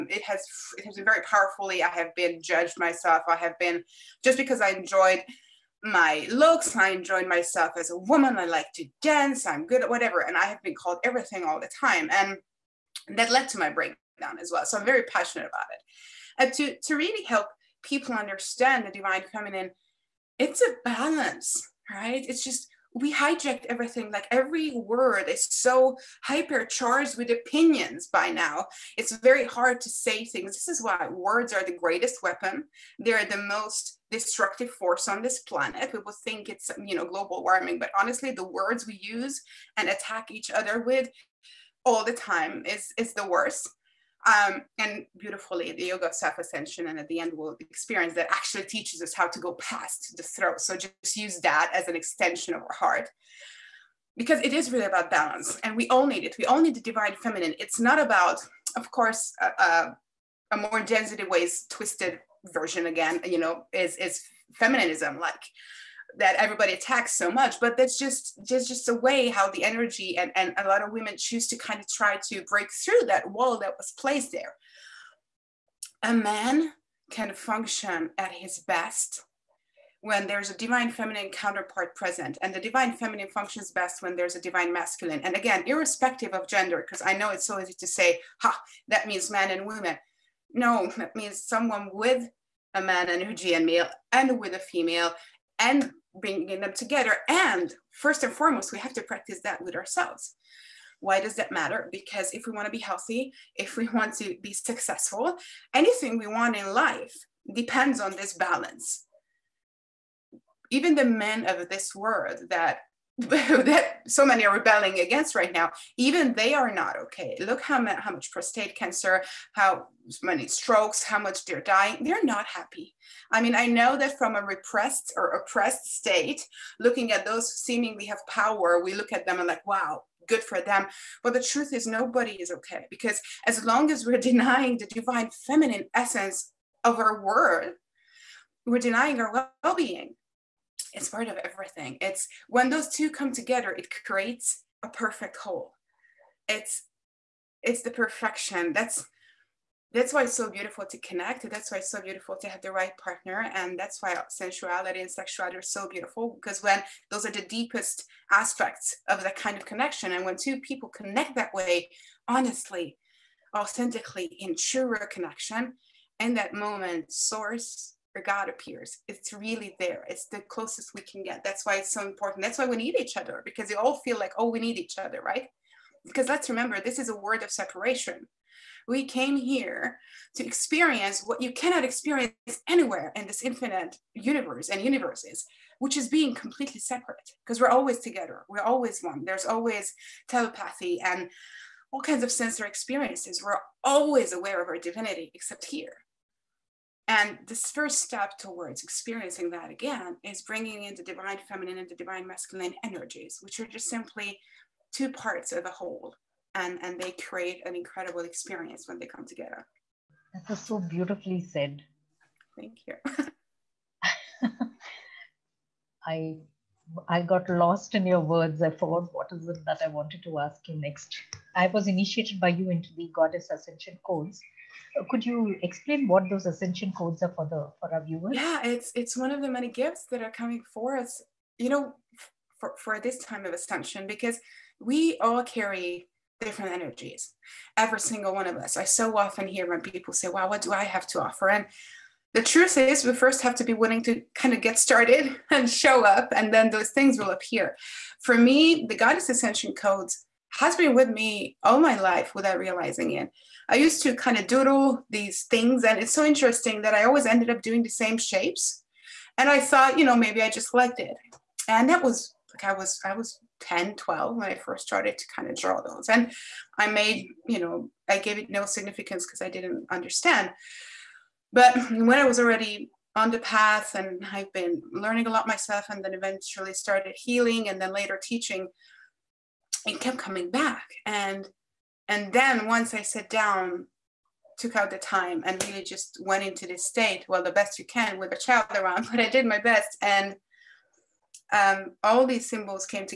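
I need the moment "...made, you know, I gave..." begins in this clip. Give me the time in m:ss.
4:26.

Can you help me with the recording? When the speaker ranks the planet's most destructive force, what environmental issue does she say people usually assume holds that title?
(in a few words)
Global warming.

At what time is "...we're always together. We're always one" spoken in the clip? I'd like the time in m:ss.
3:07.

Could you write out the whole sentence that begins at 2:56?
Because let's remember, this is a word of separation.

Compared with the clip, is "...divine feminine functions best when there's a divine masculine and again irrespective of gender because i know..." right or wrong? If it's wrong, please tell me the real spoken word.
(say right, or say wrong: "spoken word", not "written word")
right.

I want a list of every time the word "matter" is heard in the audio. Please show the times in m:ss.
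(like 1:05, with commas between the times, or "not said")
1:41.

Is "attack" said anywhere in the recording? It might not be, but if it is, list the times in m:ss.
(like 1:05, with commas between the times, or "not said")
0:39, 1:06.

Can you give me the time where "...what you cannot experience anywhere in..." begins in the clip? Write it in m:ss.
3:01.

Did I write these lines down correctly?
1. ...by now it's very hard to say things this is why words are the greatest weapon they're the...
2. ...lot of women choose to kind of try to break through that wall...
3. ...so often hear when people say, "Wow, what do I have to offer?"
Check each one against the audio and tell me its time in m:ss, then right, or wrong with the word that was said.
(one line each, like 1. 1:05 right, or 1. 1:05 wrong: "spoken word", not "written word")
1. 0:28 right
2. 1:10 right
3. 3:58 right.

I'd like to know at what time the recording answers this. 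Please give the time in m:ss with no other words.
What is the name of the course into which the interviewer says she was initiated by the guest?
3:43.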